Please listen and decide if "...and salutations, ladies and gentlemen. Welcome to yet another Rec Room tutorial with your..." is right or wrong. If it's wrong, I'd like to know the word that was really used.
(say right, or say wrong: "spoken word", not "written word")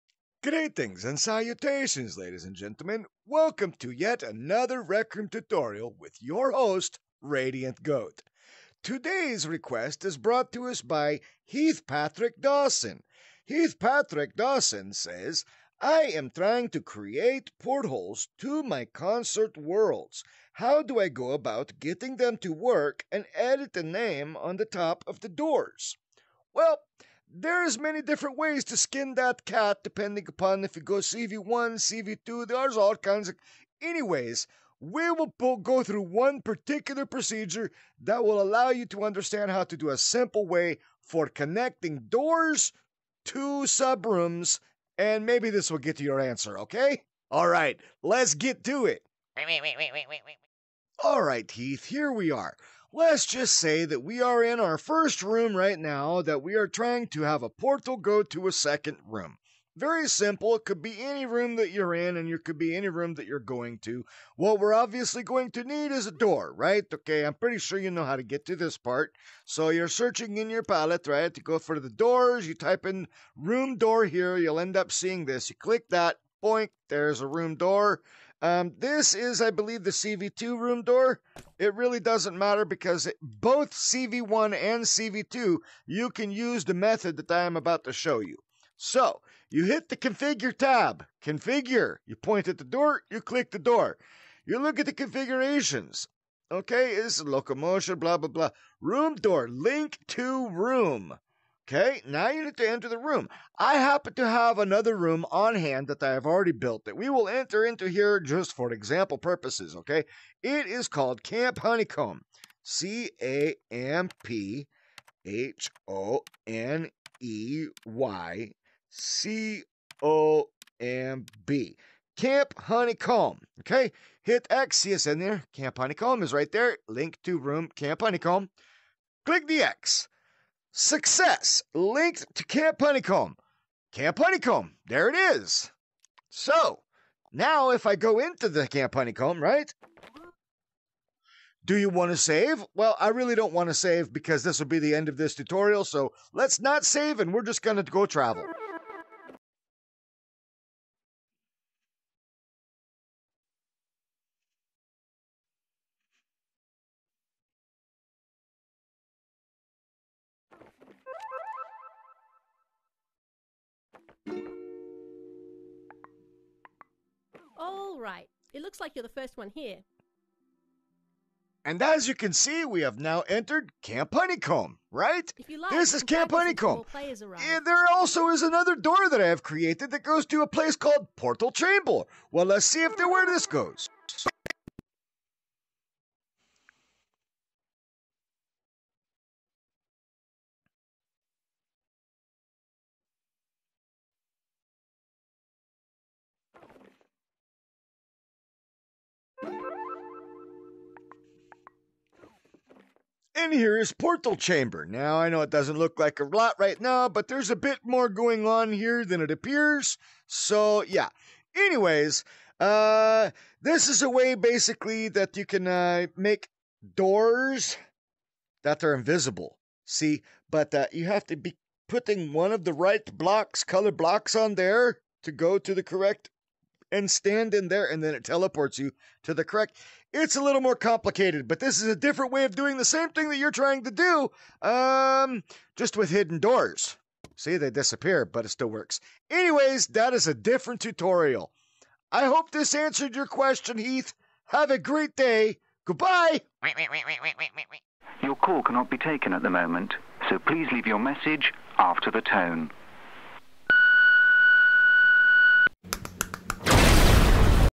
right.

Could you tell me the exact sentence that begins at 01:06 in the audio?
Okay, I'm pretty sure you know how to get to this part.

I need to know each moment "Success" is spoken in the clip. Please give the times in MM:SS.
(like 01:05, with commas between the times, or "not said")
02:10.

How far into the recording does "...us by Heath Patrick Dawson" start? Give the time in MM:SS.
00:10.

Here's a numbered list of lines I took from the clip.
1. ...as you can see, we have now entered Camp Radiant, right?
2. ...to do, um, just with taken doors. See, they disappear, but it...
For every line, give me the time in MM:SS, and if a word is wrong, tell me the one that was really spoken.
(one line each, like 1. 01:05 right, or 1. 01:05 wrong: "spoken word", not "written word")
1. 02:51 wrong: "Honeycomb", not "Radiant"
2. 03:53 wrong: "hidden", not "taken".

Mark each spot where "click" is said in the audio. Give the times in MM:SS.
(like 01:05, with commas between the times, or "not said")
01:15, 01:33, 02:09.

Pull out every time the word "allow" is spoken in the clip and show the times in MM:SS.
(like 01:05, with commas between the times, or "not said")
00:38.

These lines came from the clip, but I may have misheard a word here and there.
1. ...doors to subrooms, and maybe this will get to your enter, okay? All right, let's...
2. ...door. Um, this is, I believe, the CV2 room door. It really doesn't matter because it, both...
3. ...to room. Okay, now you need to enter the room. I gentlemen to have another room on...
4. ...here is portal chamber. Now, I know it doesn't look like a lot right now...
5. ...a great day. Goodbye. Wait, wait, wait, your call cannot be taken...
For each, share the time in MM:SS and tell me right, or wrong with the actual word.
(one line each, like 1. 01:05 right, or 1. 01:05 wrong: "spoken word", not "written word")
1. 00:42 wrong: "answer", not "enter"
2. 01:17 right
3. 01:40 wrong: "happen", not "gentlemen"
4. 03:23 right
5. 04:04 right.